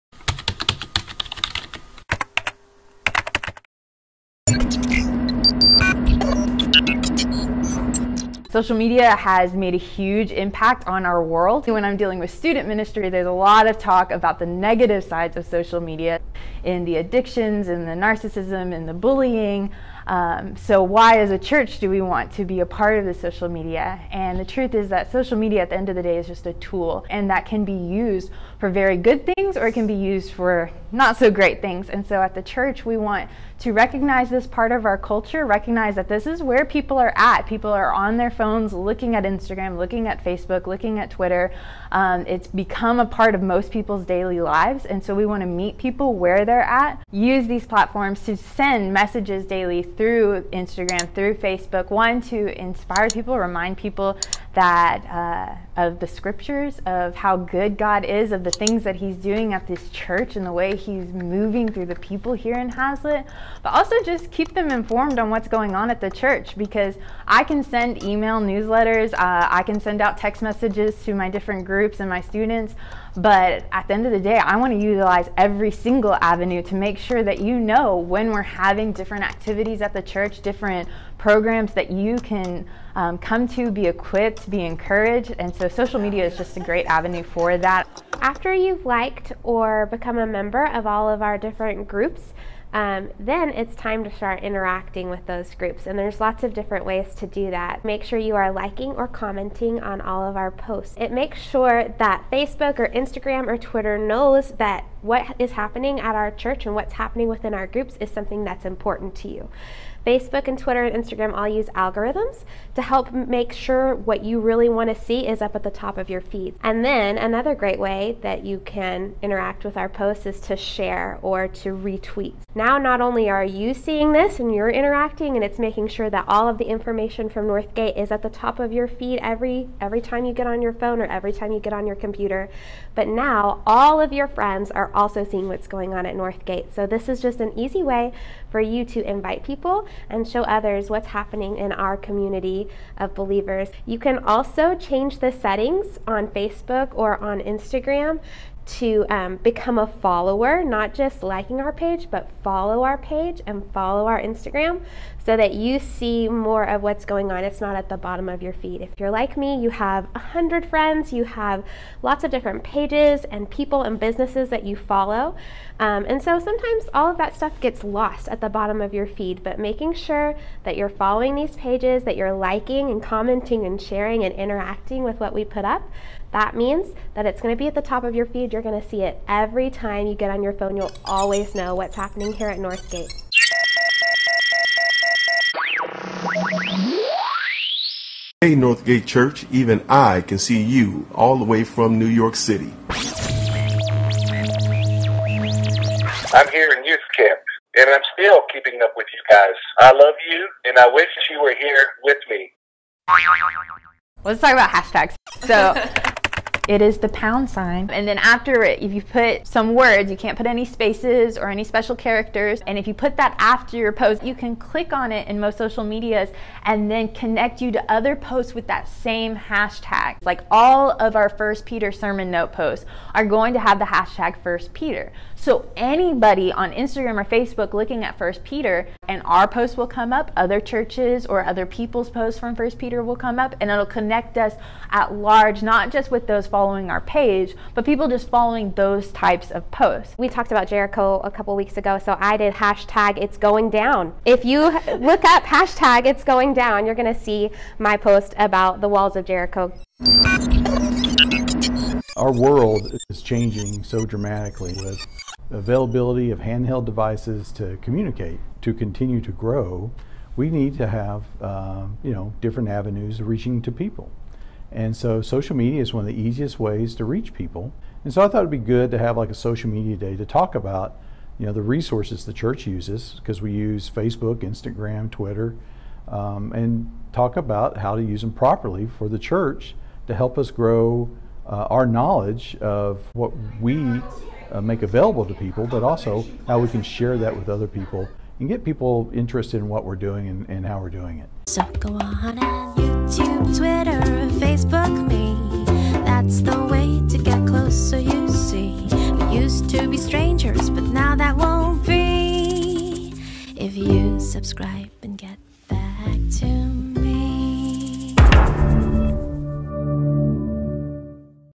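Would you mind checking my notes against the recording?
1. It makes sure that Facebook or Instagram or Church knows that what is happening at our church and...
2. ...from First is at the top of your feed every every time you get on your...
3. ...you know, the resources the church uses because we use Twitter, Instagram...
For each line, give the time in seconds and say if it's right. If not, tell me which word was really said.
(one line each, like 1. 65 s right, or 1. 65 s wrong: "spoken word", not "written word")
1. 100 s wrong: "Twitter", not "Church"
2. 127 s wrong: "Northgate", not "First"
3. 271 s wrong: "Facebook", not "Twitter".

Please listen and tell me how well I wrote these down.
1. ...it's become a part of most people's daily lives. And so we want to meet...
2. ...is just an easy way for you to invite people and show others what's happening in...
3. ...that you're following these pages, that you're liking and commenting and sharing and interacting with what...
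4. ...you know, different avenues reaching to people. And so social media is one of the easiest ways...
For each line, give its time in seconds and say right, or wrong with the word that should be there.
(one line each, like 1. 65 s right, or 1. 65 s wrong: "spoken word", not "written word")
1. 42 s right
2. 137 s right
3. 170 s right
4. 262 s right.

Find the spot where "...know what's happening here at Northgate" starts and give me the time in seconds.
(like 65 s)
181 s.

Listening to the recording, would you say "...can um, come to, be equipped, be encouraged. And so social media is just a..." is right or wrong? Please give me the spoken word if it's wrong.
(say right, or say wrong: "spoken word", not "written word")
right.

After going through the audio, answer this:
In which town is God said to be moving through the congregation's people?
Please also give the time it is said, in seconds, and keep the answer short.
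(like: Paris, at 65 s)
Hazlitt, at 62 s.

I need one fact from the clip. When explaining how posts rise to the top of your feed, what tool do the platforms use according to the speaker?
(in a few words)
algorithms.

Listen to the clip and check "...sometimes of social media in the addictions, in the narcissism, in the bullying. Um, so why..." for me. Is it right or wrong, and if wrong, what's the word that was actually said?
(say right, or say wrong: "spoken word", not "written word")
wrong: "sides", not "sometimes".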